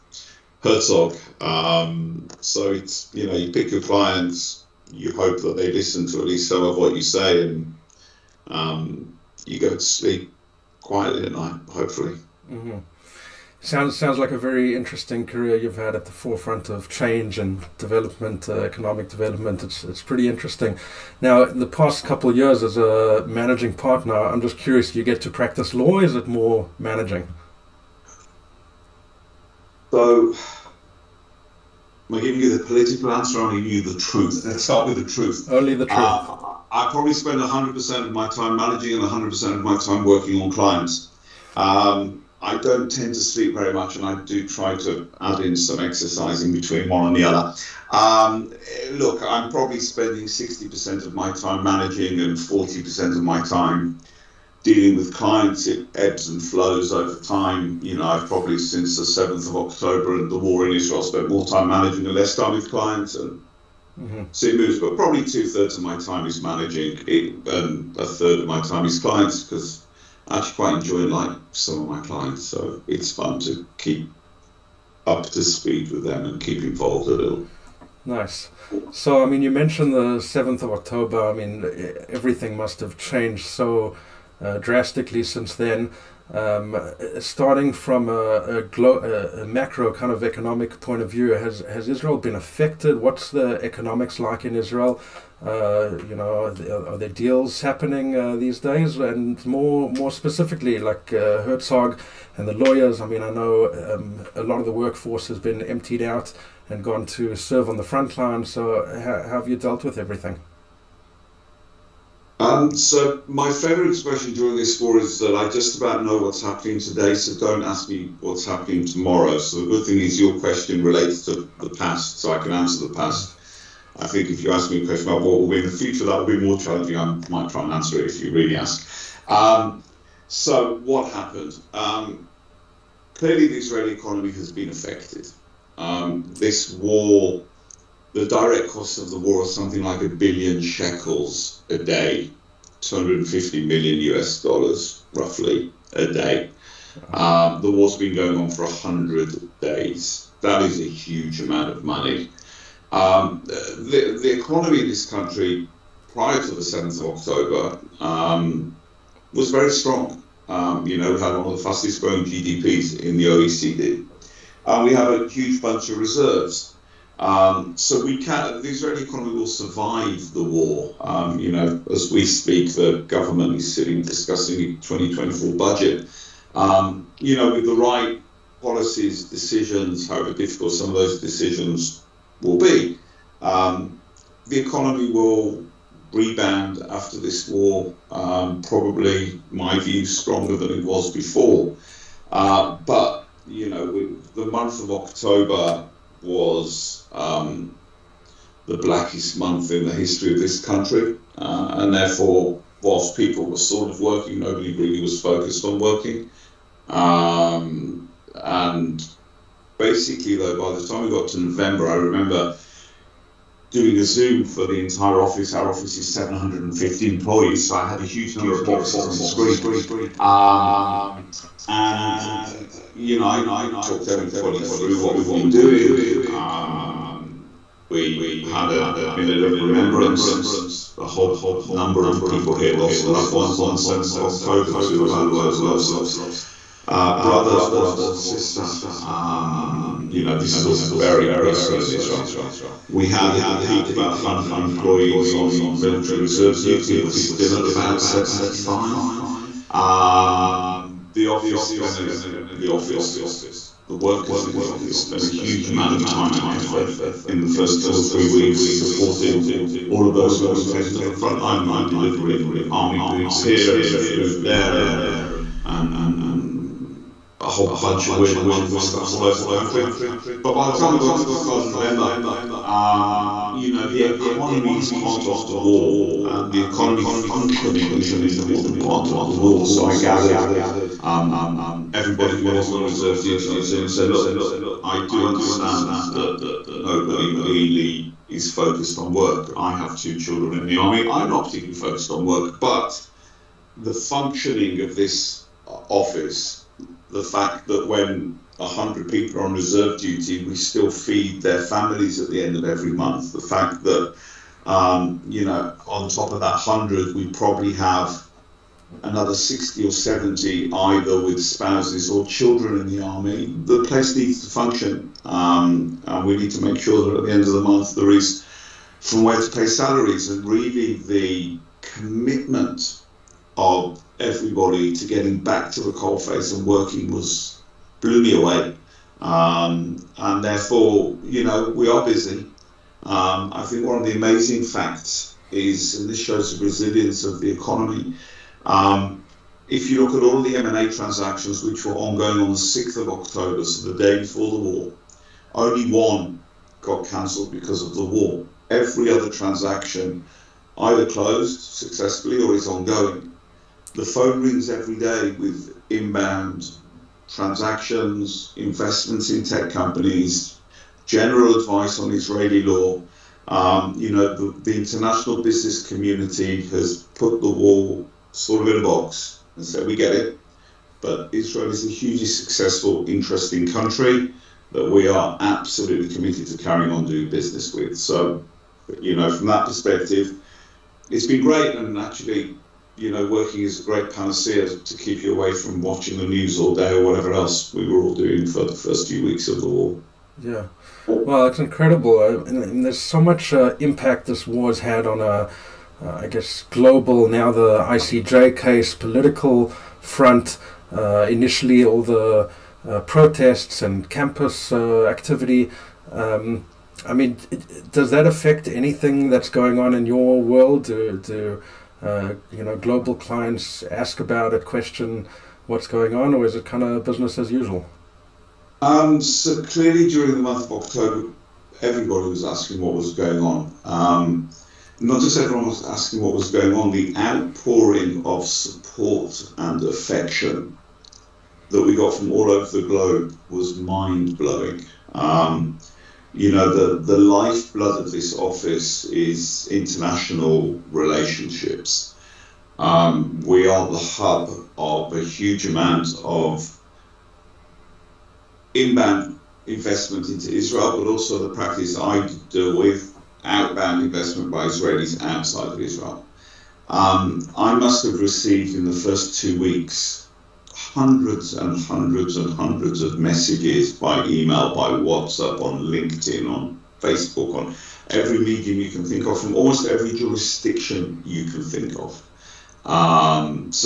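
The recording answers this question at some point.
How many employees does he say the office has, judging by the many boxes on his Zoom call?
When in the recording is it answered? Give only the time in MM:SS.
03:36.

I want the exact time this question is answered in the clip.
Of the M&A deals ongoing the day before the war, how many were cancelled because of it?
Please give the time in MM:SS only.
05:45.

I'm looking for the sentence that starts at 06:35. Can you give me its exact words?
Uh, uh, I guess, global, now the ICJ case, political front, uh, initially all the uh, protests and campus uh, activity.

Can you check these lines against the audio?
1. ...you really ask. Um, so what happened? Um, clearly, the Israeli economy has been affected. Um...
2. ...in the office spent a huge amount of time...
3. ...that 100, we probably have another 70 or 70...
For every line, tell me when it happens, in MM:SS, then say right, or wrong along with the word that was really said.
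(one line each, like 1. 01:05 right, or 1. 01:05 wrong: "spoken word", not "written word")
1. 02:08 right
2. 04:14 right
3. 05:06 wrong: "60", not "70".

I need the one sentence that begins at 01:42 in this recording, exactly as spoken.
I mean, I know um, a lot of the workforce has been emptied out and gone to serve on the front line.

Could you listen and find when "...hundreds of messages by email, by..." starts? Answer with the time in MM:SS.
07:42.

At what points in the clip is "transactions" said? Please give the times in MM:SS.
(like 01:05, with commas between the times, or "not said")
05:40, 05:49, 05:57.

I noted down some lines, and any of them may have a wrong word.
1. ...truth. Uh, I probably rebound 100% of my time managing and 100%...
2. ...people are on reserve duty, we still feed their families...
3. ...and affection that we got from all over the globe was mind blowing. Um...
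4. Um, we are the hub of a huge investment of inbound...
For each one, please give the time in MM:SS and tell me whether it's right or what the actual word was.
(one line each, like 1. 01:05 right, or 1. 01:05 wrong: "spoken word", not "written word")
1. 00:35 wrong: "spend", not "rebound"
2. 04:59 right
3. 07:09 right
4. 07:22 wrong: "amount", not "investment".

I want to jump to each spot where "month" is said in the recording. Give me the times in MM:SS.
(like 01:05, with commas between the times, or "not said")
03:14, 03:19, 05:02, 05:17, 07:00.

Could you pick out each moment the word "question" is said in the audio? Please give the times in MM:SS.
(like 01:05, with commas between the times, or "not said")
02:00, 02:04, 06:54.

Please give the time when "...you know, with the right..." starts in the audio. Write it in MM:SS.
02:57.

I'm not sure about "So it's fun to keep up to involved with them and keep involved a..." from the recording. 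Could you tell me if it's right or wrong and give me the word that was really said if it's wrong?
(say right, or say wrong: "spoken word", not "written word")
wrong: "speed", not "involved".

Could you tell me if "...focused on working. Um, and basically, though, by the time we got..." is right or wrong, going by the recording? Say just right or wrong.
right.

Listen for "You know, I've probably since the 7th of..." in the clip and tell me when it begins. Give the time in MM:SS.
00:57.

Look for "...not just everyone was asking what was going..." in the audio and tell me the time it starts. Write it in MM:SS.
07:04.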